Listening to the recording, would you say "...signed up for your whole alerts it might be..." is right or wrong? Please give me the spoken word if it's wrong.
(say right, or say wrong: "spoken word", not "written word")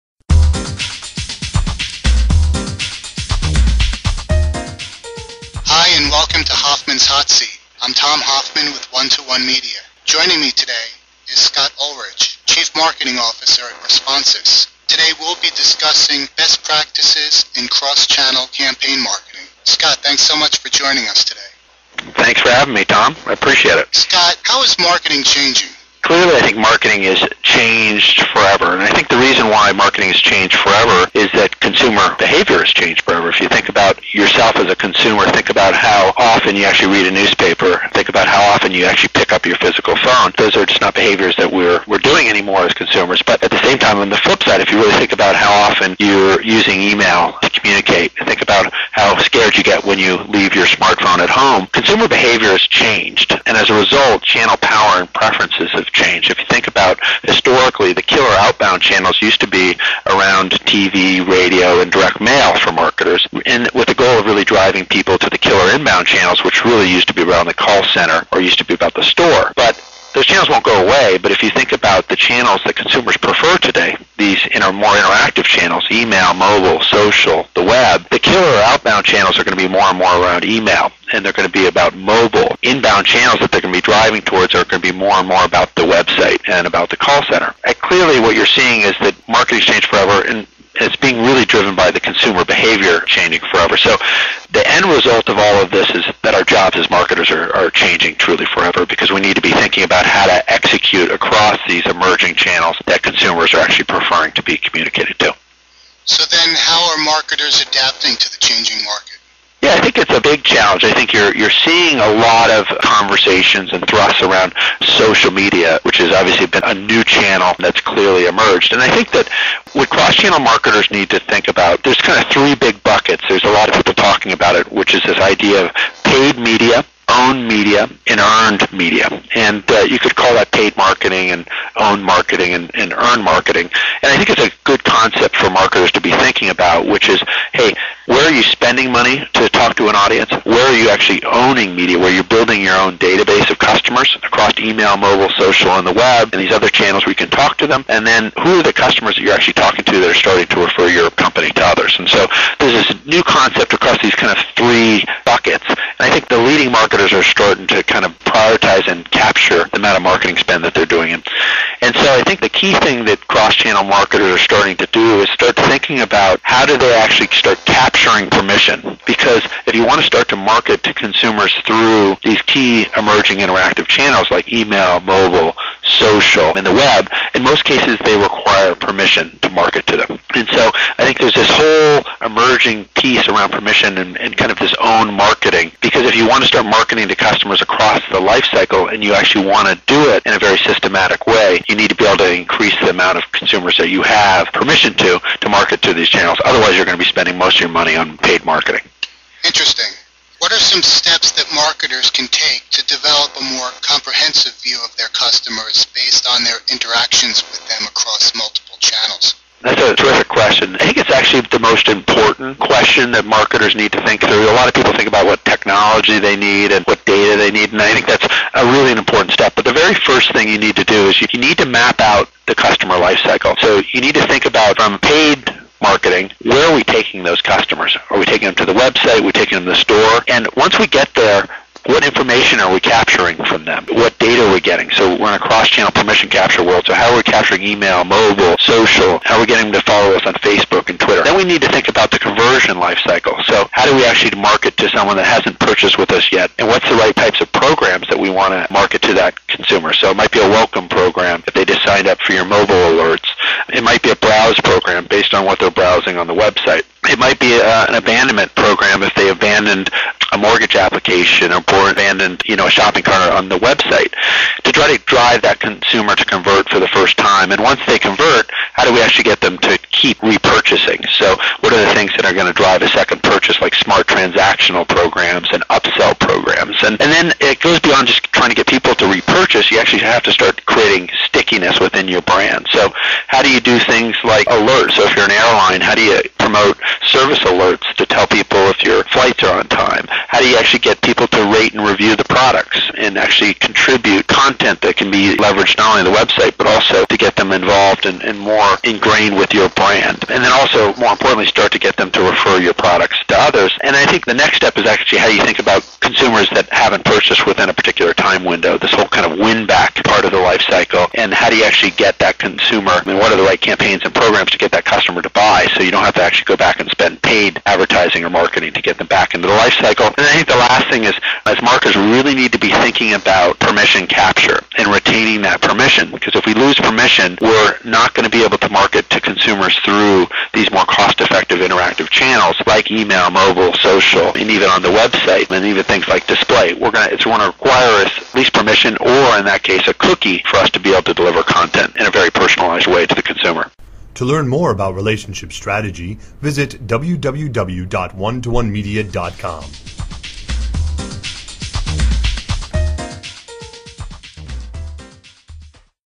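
wrong: "mobile", not "whole".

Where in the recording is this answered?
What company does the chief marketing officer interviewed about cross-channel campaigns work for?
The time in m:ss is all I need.
0:13.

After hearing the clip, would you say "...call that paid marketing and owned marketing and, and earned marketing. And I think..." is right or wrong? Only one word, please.
right.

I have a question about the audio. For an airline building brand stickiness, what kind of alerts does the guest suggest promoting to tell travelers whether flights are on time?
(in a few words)
service alerts.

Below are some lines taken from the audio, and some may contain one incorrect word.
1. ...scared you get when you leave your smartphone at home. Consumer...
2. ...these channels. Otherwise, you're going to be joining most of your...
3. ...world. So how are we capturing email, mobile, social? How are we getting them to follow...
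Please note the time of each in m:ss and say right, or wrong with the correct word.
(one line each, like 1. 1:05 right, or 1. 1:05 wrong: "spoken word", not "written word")
1. 0:49 right
2. 3:15 wrong: "spending", not "joining"
3. 3:56 right.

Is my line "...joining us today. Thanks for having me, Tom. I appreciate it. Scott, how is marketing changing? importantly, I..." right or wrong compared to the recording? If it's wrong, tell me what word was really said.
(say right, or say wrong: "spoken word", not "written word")
wrong: "clearly", not "importantly".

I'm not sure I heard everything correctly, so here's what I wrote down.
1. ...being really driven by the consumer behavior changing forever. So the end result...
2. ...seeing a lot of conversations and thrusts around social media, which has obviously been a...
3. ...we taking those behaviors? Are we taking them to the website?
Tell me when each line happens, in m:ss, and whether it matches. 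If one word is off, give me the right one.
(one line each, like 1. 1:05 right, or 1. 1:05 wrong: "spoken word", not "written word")
1. 1:30 right
2. 1:51 right
3. 3:46 wrong: "customers", not "behaviors".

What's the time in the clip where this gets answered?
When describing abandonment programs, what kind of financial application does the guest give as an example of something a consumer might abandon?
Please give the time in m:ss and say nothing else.
4:20.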